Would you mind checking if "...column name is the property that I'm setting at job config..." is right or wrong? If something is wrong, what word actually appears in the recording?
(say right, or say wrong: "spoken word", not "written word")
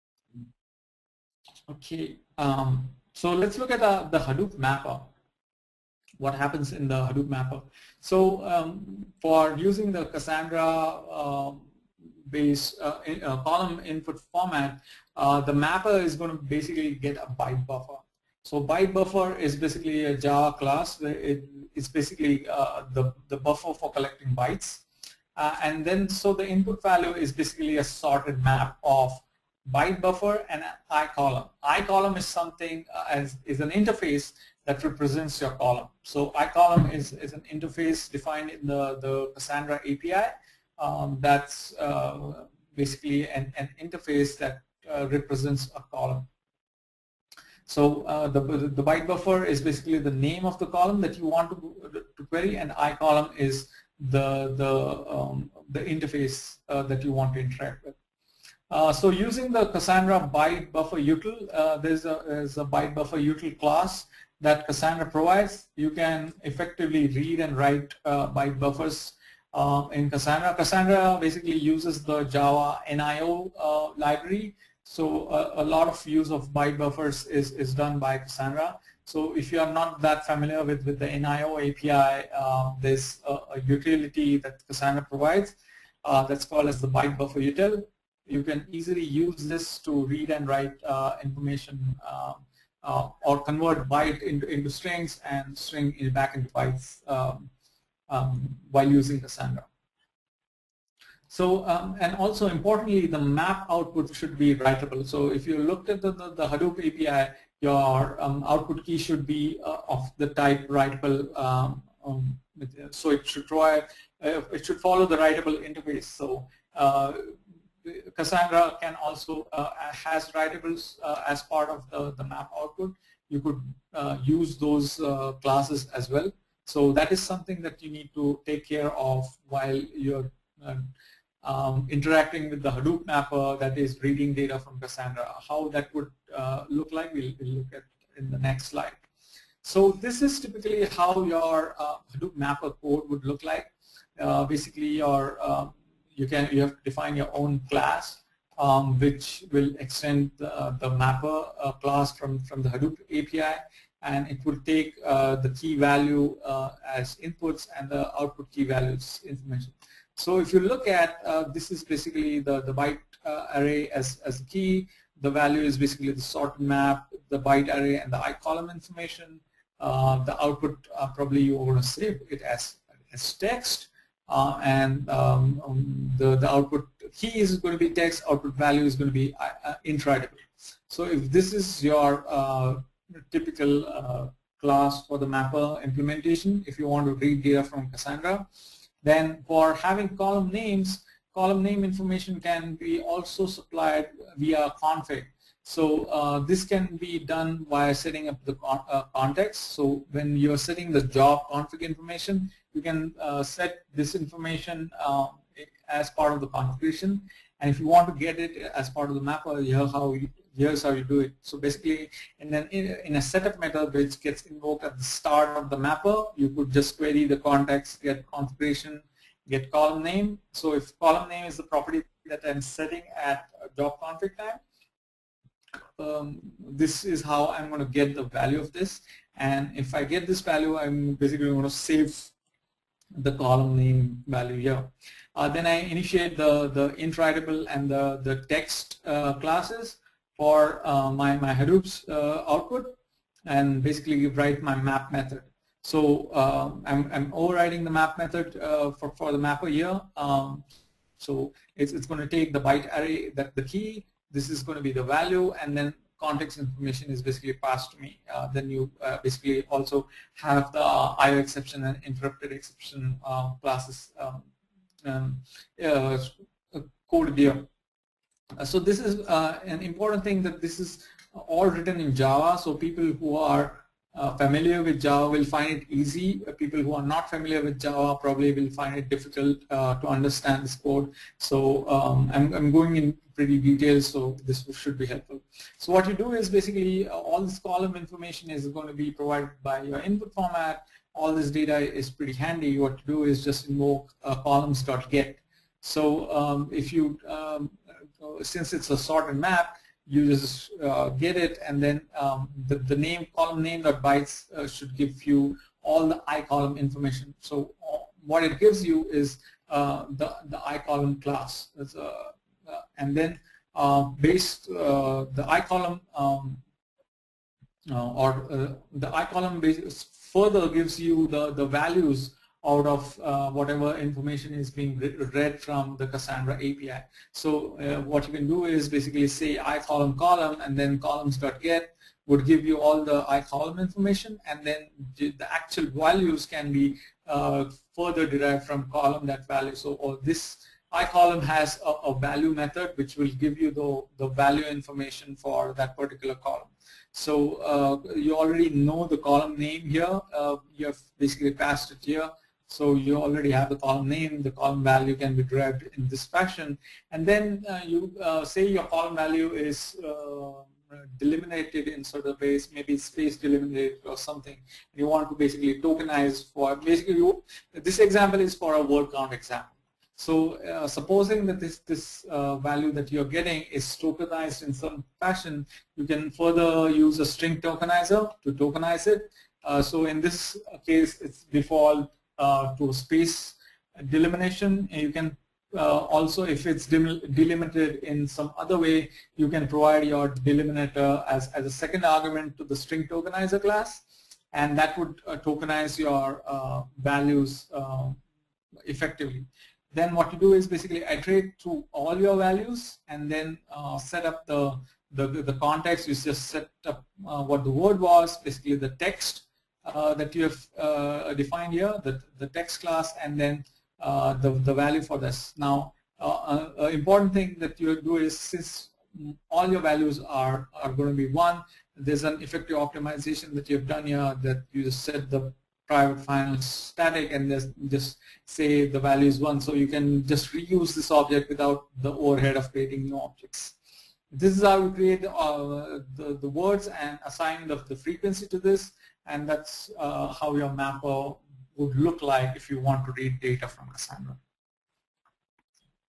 right.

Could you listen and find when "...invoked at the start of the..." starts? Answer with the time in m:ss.
3:34.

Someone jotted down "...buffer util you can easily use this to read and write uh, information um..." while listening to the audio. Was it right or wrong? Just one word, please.
right.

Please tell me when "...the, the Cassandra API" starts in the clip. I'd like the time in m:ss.
0:38.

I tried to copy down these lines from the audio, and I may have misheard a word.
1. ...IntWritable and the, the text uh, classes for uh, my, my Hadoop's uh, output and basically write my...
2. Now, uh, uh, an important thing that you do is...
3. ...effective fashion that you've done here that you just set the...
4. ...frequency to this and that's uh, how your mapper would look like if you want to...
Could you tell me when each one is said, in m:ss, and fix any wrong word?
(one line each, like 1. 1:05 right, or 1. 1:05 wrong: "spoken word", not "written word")
1. 3:56 right
2. 6:55 right
3. 7:02 wrong: "optimization", not "fashion"
4. 7:17 right.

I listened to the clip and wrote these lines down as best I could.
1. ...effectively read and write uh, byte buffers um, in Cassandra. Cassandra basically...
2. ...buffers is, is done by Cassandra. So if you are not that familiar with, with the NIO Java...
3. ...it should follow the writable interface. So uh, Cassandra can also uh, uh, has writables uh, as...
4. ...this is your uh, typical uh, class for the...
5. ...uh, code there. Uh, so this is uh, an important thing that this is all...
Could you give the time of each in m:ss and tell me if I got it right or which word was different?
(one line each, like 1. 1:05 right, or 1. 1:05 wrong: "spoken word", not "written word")
1. 1:06 right
2. 1:16 wrong: "API", not "Java"
3. 1:54 right
4. 3:01 right
5. 4:25 right.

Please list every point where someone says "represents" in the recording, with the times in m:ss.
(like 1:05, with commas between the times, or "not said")
0:34, 0:45.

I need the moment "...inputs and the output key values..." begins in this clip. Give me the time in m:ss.
2:37.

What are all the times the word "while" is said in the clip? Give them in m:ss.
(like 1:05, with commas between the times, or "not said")
1:38, 2:09.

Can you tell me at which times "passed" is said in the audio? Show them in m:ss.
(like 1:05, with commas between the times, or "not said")
4:17, 5:51.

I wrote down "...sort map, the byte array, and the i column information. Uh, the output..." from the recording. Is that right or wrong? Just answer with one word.
right.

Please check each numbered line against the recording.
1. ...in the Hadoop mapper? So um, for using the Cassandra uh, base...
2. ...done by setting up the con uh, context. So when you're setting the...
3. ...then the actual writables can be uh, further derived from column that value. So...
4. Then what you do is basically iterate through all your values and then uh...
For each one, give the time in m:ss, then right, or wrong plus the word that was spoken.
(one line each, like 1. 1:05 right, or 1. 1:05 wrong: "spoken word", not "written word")
1. 0:06 right
2. 3:17 right
3. 5:34 wrong: "values", not "writables"
4. 6:39 right.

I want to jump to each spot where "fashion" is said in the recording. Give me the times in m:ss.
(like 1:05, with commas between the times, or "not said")
5:56, 6:15.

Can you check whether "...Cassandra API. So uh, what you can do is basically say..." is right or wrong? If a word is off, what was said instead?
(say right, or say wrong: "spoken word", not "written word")
right.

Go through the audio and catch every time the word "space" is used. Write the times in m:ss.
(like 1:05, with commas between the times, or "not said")
6:02, 6:22.